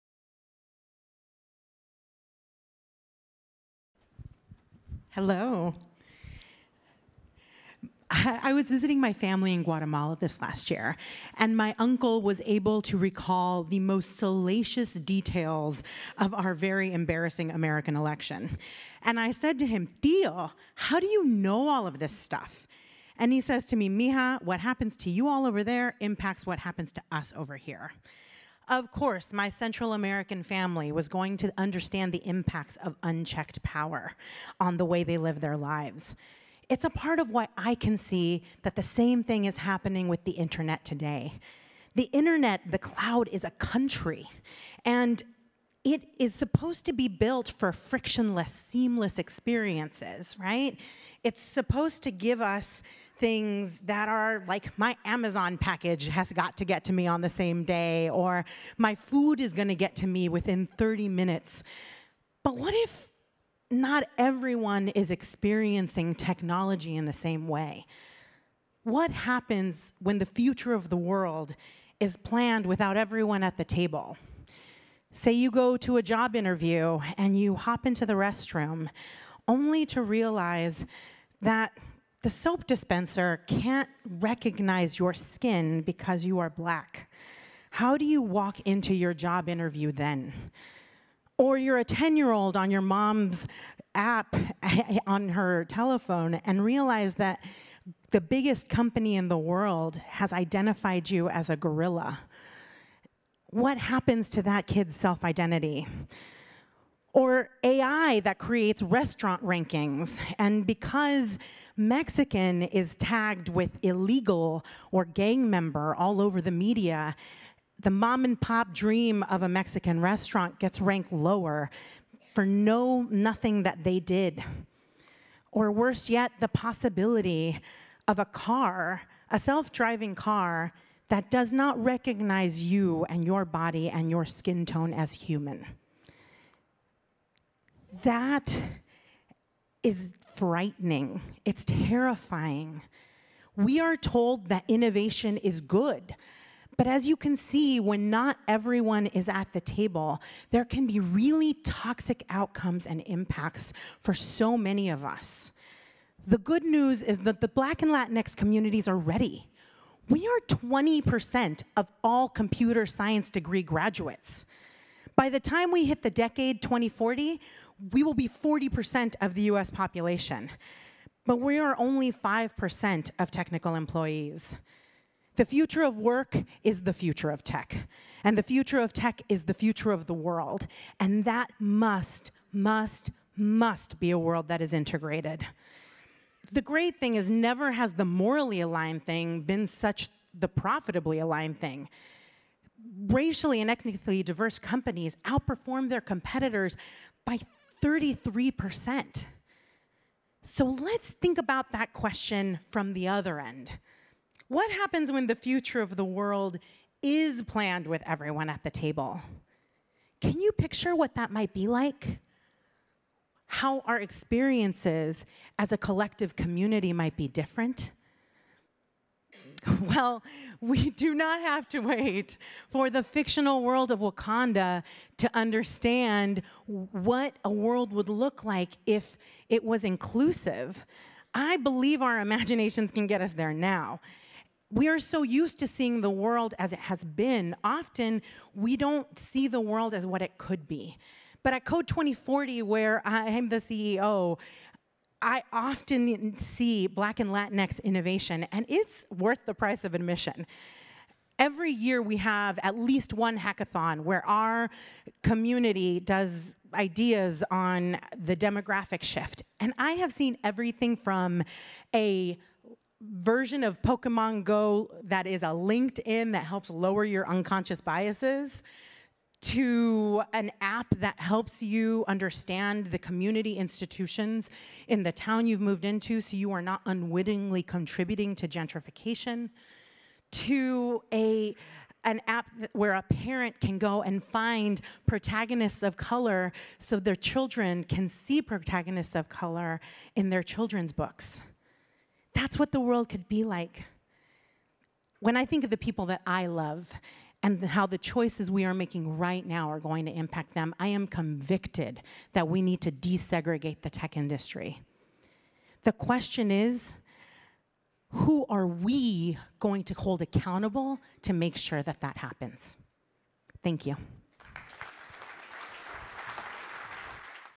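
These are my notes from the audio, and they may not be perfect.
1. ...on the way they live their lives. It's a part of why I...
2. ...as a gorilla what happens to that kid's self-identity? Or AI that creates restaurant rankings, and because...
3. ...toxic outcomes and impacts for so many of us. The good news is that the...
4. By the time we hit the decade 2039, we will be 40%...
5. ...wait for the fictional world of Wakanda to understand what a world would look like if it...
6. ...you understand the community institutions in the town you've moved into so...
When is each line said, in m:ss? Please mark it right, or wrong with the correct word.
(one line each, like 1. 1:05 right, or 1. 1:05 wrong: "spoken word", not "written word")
1. 0:34 right
2. 1:41 right
3. 2:31 right
4. 2:45 wrong: "2040", not "2039"
5. 3:41 right
6. 4:31 right.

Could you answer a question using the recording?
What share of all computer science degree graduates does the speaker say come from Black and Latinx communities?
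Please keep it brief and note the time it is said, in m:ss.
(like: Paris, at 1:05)
20%, at 2:40.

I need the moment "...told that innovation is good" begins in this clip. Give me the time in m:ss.
2:23.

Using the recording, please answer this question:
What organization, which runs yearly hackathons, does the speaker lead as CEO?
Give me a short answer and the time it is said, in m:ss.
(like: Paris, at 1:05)
Code 2040, at 4:01.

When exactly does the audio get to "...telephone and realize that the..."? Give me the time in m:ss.
1:35.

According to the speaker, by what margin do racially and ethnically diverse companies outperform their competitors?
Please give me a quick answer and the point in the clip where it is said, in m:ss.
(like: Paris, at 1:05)
33%, at 3:17.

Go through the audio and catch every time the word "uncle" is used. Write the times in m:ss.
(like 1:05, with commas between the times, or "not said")
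0:11.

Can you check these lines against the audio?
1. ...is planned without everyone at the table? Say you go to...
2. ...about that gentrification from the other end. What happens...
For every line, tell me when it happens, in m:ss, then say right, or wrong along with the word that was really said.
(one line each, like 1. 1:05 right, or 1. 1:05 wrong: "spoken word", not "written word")
1. 1:11 right
2. 3:21 wrong: "question", not "gentrification".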